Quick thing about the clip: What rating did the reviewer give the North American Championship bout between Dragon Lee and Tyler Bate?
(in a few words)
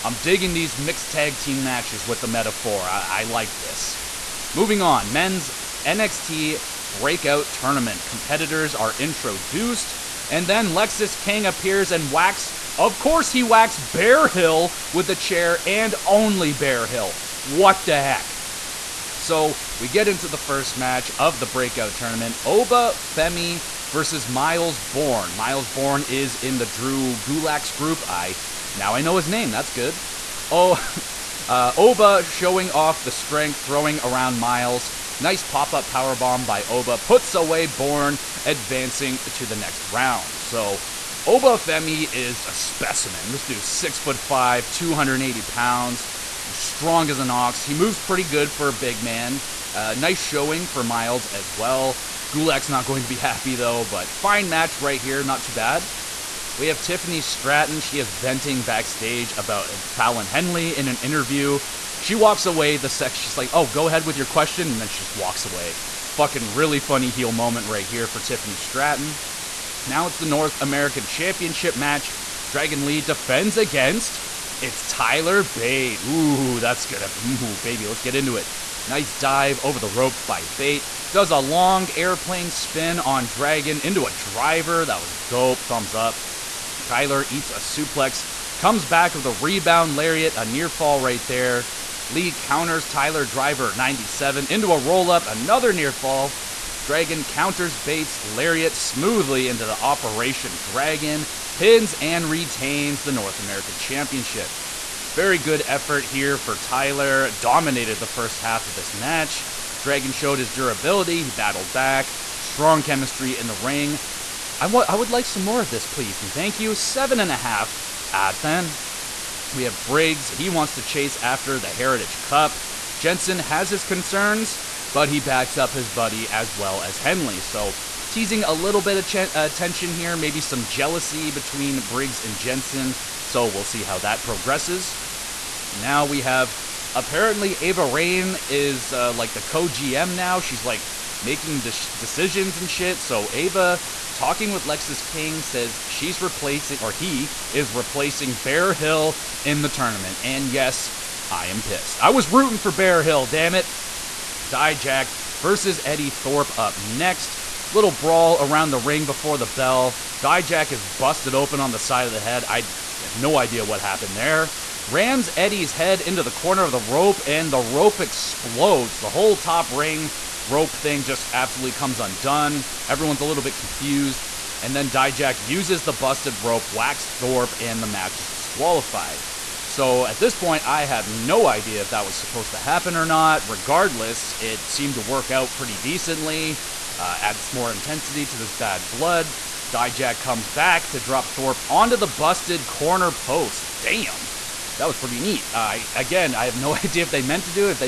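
7.5.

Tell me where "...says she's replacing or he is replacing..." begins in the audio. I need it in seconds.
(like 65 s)
145 s.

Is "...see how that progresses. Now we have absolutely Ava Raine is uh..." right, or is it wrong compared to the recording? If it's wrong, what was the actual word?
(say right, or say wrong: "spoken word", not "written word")
wrong: "apparently", not "absolutely".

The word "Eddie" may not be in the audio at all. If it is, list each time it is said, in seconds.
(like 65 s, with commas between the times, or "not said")
155 s, 165 s.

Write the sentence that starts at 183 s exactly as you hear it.
Regardless, it seemed to work out pretty decently, uh, adds more intensity to this bad blood.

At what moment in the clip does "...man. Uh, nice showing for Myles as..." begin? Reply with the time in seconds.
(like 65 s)
49 s.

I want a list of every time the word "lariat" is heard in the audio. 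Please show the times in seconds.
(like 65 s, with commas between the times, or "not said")
89 s, 98 s.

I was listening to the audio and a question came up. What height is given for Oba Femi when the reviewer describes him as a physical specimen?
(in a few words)
6 foot 5.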